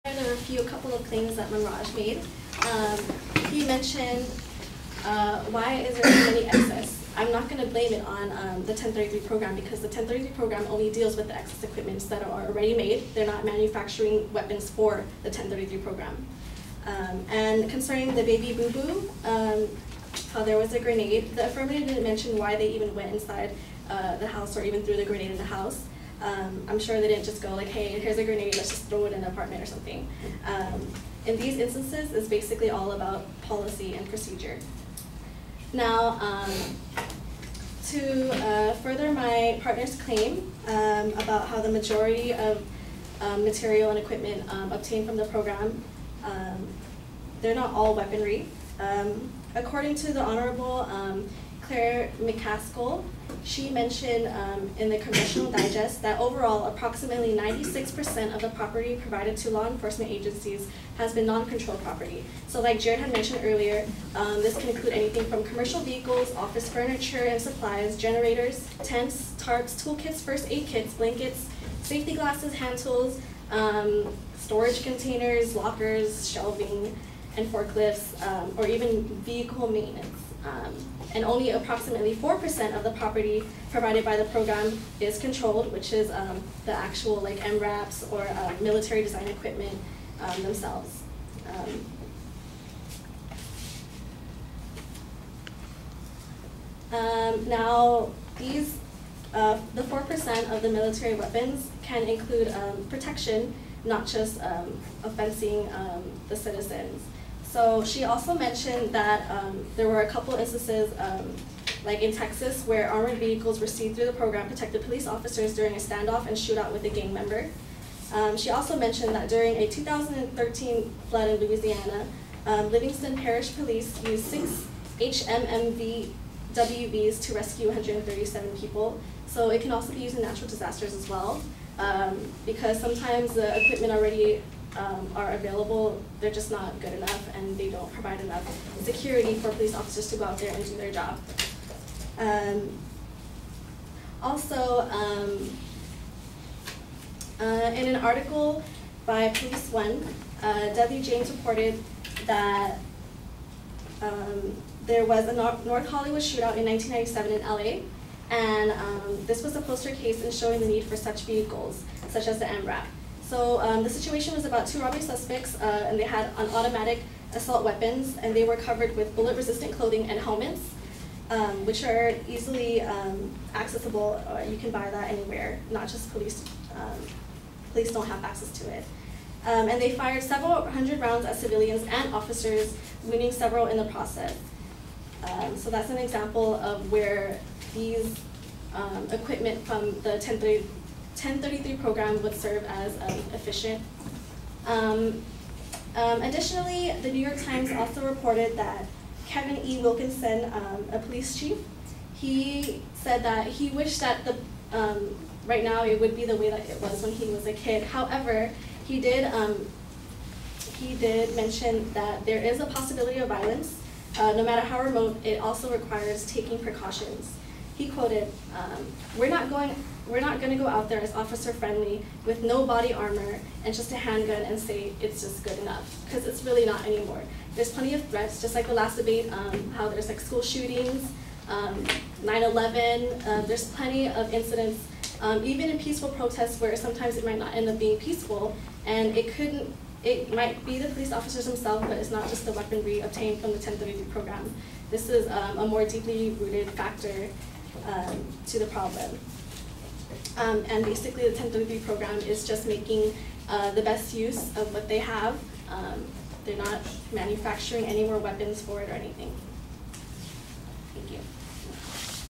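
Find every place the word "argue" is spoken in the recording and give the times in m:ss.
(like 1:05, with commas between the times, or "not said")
not said.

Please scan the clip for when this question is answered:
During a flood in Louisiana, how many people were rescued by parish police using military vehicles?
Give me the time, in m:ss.
2:07.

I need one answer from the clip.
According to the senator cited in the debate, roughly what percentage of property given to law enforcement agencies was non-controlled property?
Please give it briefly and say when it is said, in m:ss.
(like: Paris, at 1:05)
96%, at 0:57.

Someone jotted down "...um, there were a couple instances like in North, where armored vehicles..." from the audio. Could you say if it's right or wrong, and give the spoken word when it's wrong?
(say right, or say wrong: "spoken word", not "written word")
wrong: "Texas", not "North".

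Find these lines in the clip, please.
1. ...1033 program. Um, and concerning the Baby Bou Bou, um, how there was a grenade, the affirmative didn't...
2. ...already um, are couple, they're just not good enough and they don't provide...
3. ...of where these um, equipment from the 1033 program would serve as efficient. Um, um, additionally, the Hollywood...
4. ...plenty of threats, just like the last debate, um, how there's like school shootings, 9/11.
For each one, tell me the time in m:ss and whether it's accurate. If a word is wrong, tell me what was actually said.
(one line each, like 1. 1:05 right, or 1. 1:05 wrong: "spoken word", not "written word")
1. 0:15 right
2. 2:13 wrong: "available", not "couple"
3. 3:06 wrong: "New", not "Hollywood"
4. 3:47 right.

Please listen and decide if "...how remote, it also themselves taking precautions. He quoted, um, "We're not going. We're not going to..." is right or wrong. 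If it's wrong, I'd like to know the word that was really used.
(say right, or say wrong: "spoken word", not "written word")
wrong: "requires", not "themselves".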